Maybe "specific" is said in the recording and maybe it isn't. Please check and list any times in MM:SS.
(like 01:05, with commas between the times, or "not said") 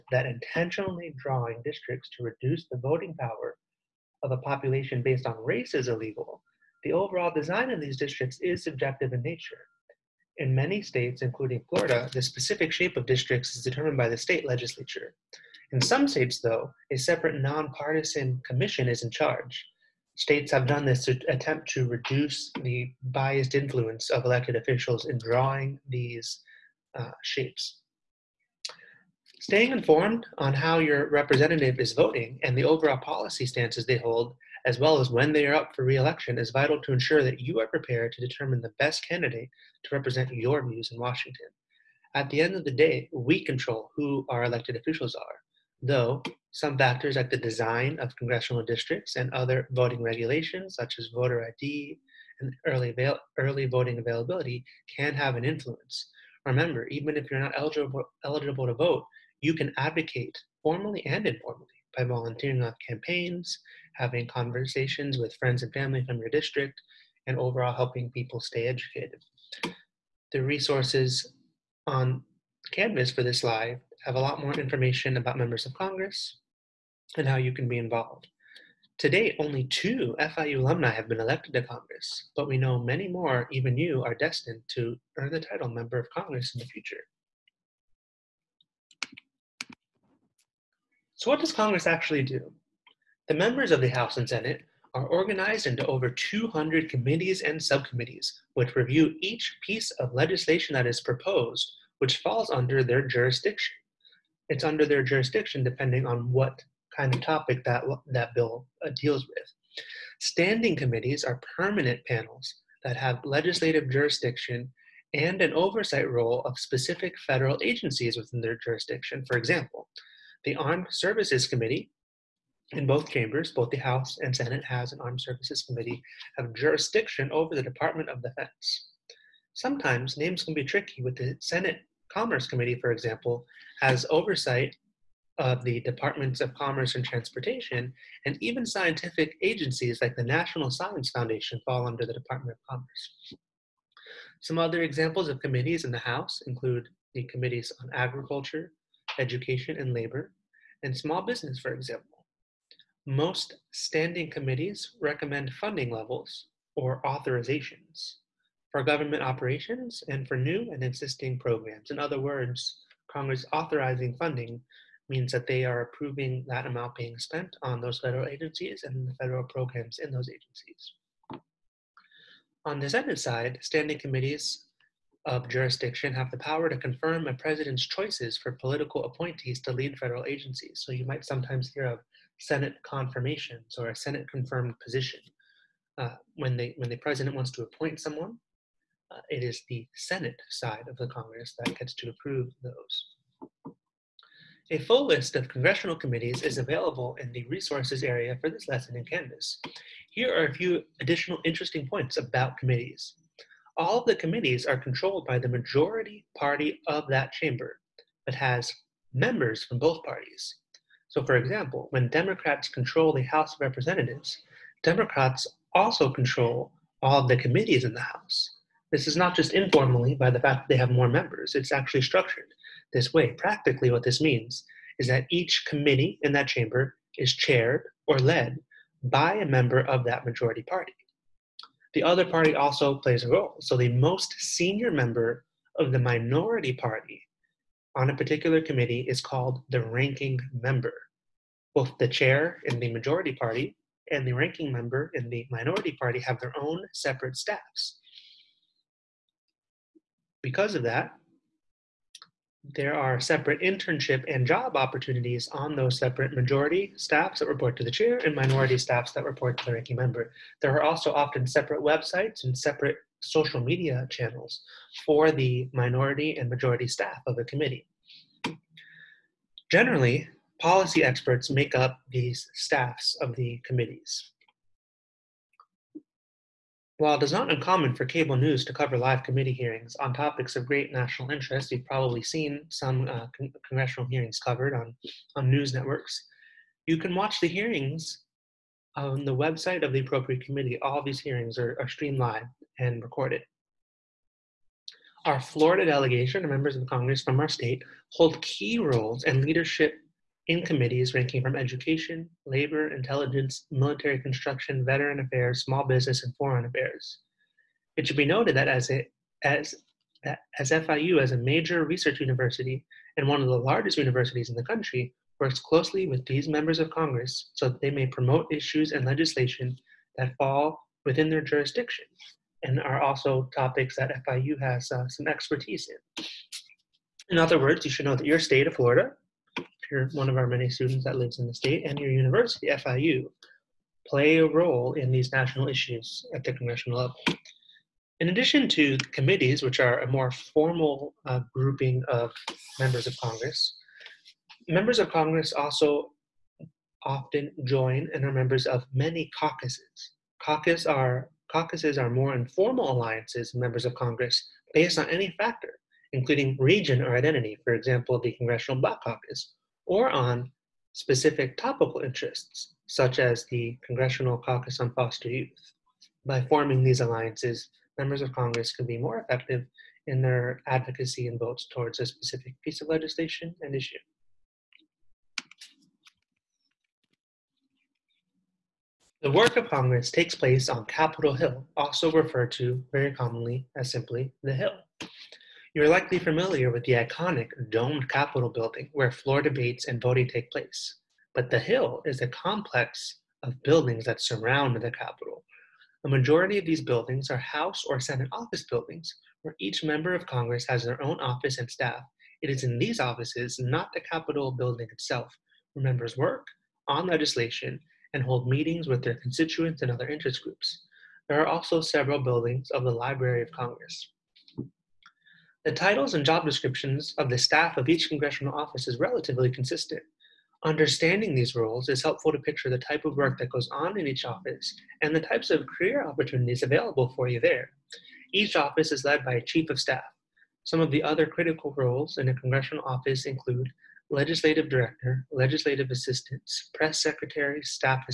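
00:12, 01:56, 06:00, 06:12.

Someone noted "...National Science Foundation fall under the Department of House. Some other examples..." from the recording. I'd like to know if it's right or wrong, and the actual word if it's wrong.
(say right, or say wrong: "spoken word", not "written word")
wrong: "Commerce", not "House".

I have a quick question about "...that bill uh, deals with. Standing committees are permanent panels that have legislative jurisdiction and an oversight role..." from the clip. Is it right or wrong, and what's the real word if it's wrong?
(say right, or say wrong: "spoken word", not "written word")
right.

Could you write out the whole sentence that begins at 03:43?
Practically, what this means is that each committee in that chamber is chaired or led by a member of that majority party.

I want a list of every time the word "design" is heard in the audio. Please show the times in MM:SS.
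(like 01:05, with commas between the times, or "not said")
00:07, 00:47.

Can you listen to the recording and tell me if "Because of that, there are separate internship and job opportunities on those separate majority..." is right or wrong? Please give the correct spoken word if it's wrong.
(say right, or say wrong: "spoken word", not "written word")
right.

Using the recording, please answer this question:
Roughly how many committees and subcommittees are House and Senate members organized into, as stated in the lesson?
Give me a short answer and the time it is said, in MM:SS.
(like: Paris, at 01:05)
over 200, at 01:35.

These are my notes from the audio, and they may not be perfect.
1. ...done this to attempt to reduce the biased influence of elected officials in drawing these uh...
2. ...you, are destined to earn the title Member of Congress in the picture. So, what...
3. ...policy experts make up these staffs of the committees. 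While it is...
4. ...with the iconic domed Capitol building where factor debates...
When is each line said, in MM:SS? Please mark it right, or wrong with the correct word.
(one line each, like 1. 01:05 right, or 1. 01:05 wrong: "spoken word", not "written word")
1. 00:20 right
2. 01:23 wrong: "future", not "picture"
3. 04:30 right
4. 06:26 wrong: "floor", not "factor".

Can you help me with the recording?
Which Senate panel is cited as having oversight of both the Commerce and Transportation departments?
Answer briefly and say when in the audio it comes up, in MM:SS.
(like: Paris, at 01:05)
Senate Commerce Committee, at 02:11.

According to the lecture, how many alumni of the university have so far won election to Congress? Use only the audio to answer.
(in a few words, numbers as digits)
2.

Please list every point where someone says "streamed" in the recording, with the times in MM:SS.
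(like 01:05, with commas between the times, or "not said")
04:51.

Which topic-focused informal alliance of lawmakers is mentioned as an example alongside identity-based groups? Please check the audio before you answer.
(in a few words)
Congressional Caucus on Foster Youth.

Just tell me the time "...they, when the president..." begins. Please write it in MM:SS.
03:06.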